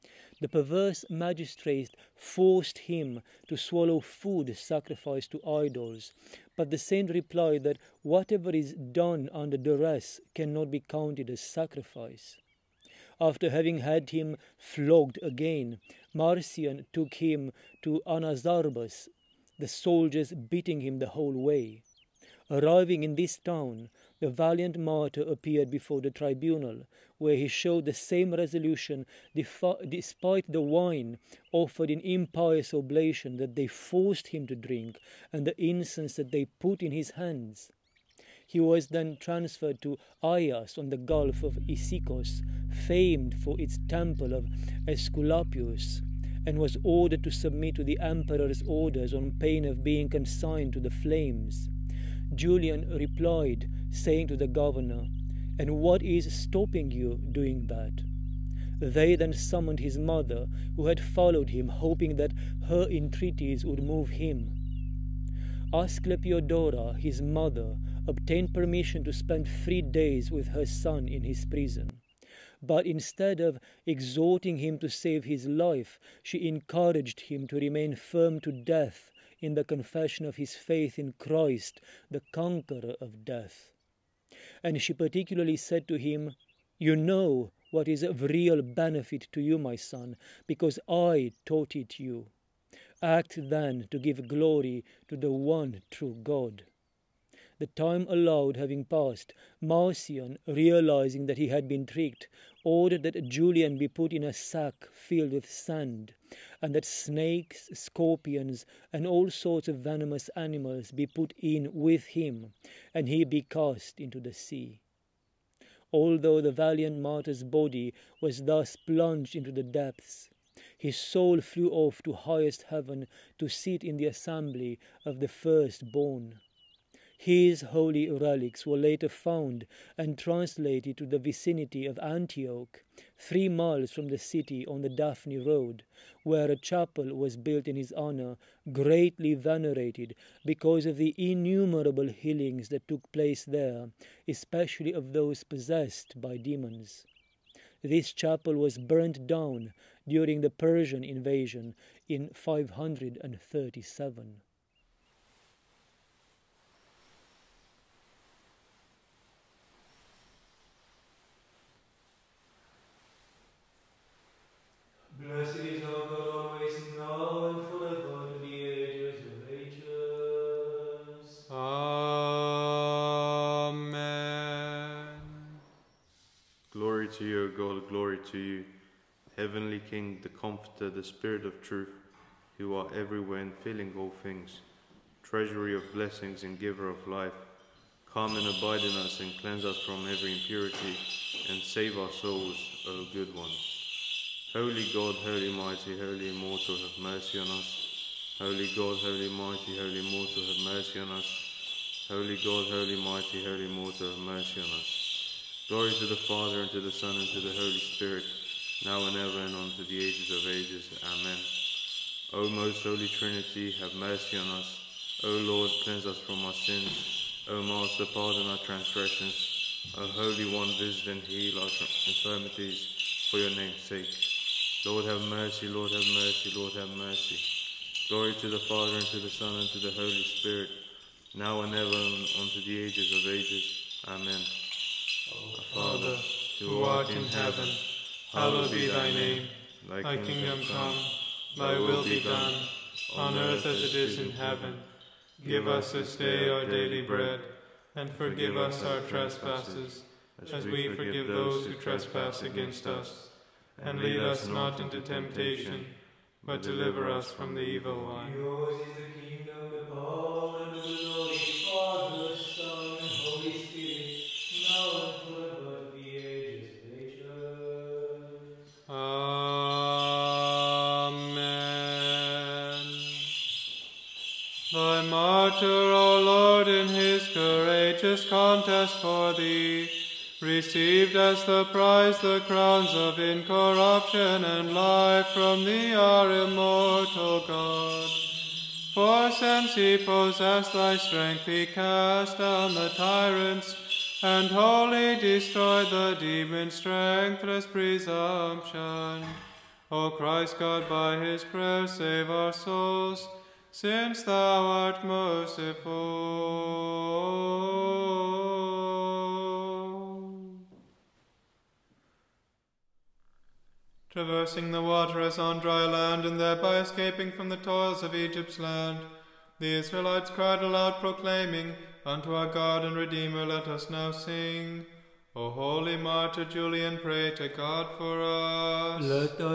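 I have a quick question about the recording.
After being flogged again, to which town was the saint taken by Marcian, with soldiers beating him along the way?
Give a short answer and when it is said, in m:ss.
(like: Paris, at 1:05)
Anazarbus, at 0:18.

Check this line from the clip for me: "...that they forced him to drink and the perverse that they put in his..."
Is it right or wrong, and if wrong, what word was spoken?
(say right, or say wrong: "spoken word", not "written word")
wrong: "incense", not "perverse".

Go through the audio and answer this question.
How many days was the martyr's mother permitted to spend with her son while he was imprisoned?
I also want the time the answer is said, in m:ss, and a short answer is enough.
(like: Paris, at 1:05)
3, at 1:09.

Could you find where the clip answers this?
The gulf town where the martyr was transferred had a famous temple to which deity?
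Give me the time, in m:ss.
0:44.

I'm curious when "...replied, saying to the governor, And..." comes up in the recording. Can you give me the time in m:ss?
0:52.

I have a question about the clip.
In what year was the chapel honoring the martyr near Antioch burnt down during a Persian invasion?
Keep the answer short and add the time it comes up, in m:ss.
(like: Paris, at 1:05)
537, at 2:32.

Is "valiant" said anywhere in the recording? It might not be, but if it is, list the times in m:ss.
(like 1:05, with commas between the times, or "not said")
0:24, 1:56.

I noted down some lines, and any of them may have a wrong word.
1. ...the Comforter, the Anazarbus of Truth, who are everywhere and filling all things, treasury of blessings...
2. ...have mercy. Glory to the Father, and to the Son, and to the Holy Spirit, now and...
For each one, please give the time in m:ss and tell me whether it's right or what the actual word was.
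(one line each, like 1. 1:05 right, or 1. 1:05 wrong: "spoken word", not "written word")
1. 3:00 wrong: "Spirit", not "Anazarbus"
2. 3:46 right.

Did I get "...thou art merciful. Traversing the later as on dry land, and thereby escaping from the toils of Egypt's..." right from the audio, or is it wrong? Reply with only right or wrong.
wrong.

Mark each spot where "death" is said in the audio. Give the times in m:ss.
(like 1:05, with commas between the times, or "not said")
1:18, 1:23.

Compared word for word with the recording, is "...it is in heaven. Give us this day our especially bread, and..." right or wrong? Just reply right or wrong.
wrong.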